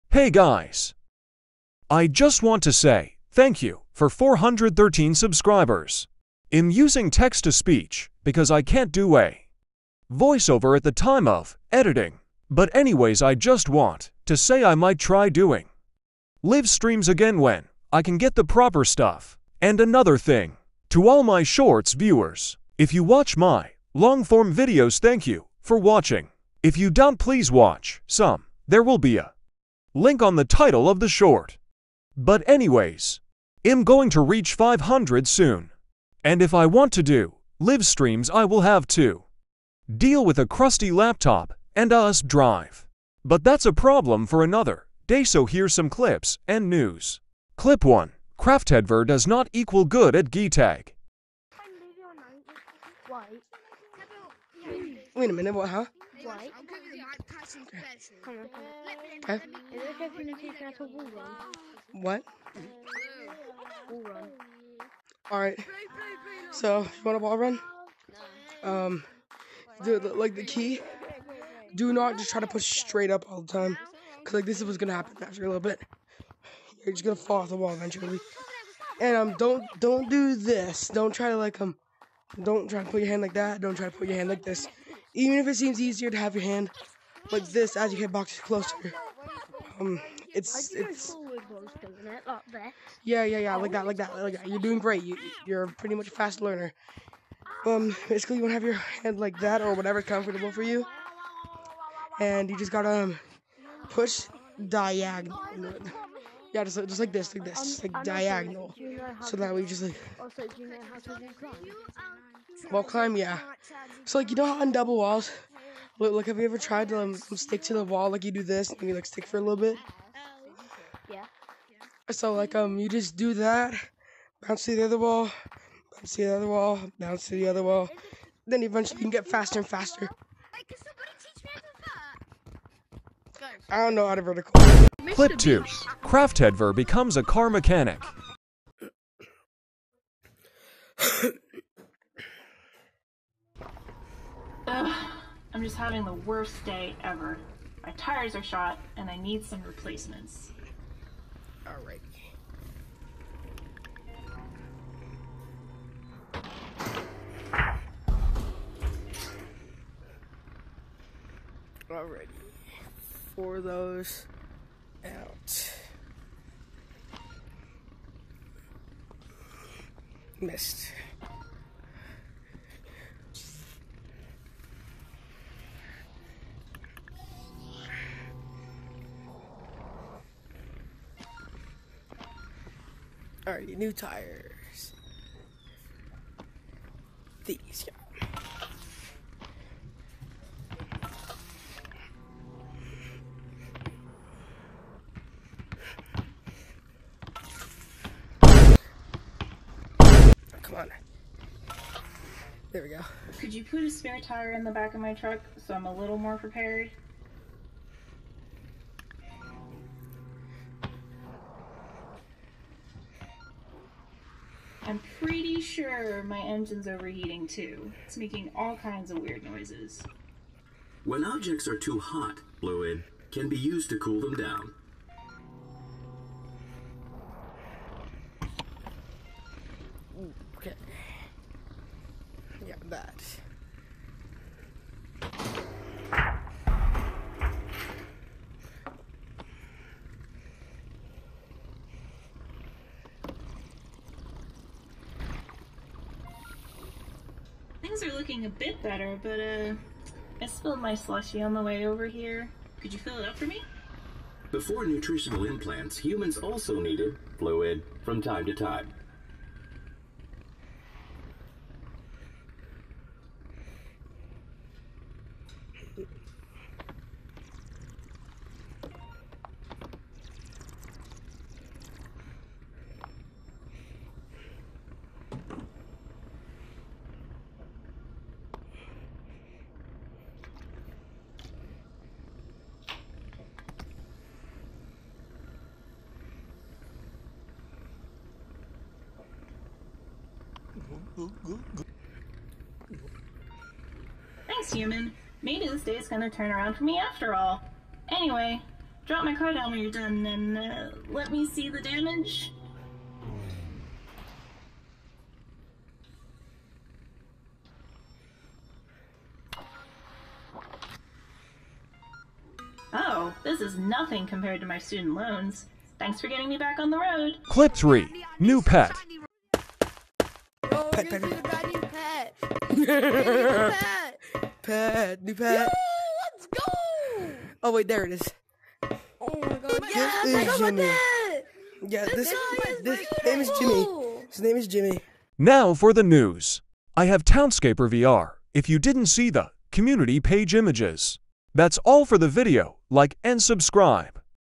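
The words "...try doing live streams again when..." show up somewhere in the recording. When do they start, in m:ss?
0:14.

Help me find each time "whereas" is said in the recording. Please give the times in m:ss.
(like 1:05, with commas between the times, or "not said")
not said.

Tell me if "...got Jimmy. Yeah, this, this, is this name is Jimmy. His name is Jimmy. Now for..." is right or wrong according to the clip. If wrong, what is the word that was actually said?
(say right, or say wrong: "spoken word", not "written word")
right.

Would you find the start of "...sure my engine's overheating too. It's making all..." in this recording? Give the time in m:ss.
3:35.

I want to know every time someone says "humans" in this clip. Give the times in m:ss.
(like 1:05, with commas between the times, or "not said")
4:15, 4:54.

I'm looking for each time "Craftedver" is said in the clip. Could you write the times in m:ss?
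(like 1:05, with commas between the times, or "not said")
0:48.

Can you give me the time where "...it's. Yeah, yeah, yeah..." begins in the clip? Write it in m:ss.
1:30.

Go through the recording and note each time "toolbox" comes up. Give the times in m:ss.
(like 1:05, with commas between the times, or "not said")
not said.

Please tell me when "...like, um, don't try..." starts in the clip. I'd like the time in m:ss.
1:21.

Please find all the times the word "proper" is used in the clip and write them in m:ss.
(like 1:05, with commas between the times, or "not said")
0:18.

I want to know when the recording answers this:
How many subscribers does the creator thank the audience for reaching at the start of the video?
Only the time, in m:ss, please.
0:04.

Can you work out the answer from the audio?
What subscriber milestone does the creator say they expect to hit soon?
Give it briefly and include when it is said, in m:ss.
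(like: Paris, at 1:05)
500, at 0:34.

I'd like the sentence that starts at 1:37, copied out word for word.
Um, basically, you want to have your hand like that or whatever's comfortable for you, and you just gotta um, push diagonal.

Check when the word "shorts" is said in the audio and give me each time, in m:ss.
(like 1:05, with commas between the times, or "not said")
0:21, 0:31.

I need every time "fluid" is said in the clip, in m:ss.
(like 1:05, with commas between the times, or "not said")
3:42, 4:17.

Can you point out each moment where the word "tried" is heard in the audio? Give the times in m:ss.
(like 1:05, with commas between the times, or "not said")
1:56.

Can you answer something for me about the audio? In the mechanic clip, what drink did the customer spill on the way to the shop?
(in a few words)
Slushy.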